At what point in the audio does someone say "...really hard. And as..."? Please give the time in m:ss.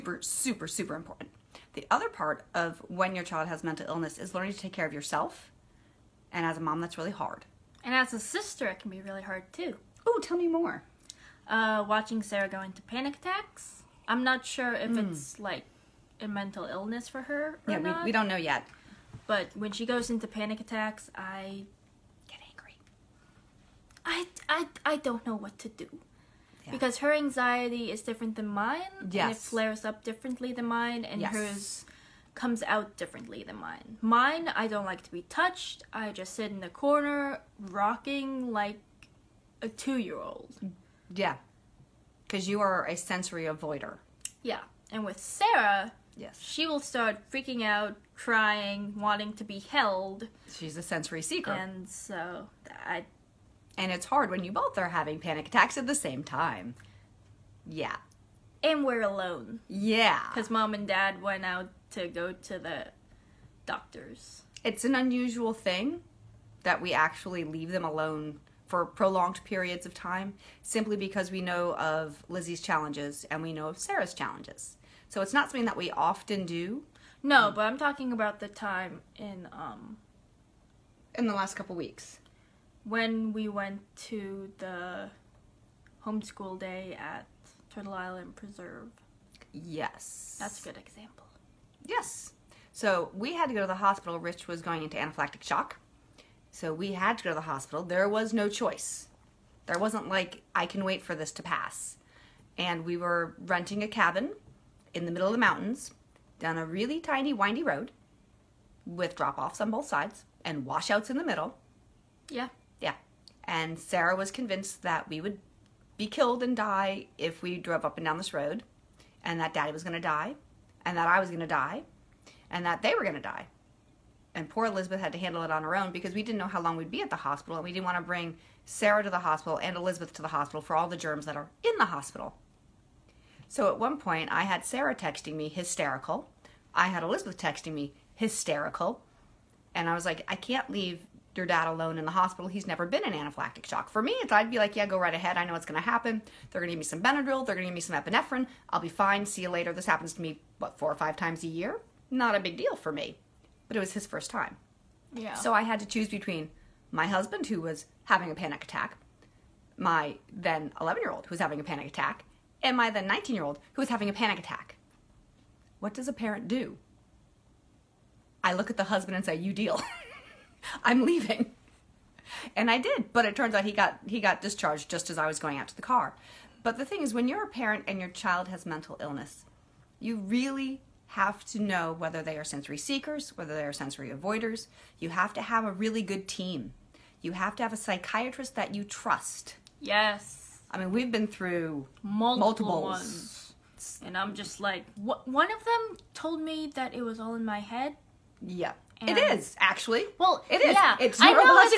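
0:06.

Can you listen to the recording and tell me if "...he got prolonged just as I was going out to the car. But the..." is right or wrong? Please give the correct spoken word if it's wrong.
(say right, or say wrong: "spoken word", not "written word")
wrong: "discharged", not "prolonged".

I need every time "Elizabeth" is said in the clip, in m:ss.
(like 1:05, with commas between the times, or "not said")
2:04, 2:09, 2:17.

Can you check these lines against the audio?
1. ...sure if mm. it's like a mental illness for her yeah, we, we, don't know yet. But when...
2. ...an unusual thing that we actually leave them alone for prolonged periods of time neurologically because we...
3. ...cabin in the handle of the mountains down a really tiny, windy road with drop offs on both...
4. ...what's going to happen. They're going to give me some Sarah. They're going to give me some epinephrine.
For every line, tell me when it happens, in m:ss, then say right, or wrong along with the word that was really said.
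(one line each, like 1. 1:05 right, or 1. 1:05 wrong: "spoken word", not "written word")
1. 0:14 right
2. 1:04 wrong: "simply", not "neurologically"
3. 1:43 wrong: "middle", not "handle"
4. 2:25 wrong: "Benadryl", not "Sarah".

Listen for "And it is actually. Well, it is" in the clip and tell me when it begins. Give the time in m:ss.
3:19.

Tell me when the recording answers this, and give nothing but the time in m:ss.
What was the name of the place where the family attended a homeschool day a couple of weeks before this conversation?
1:27.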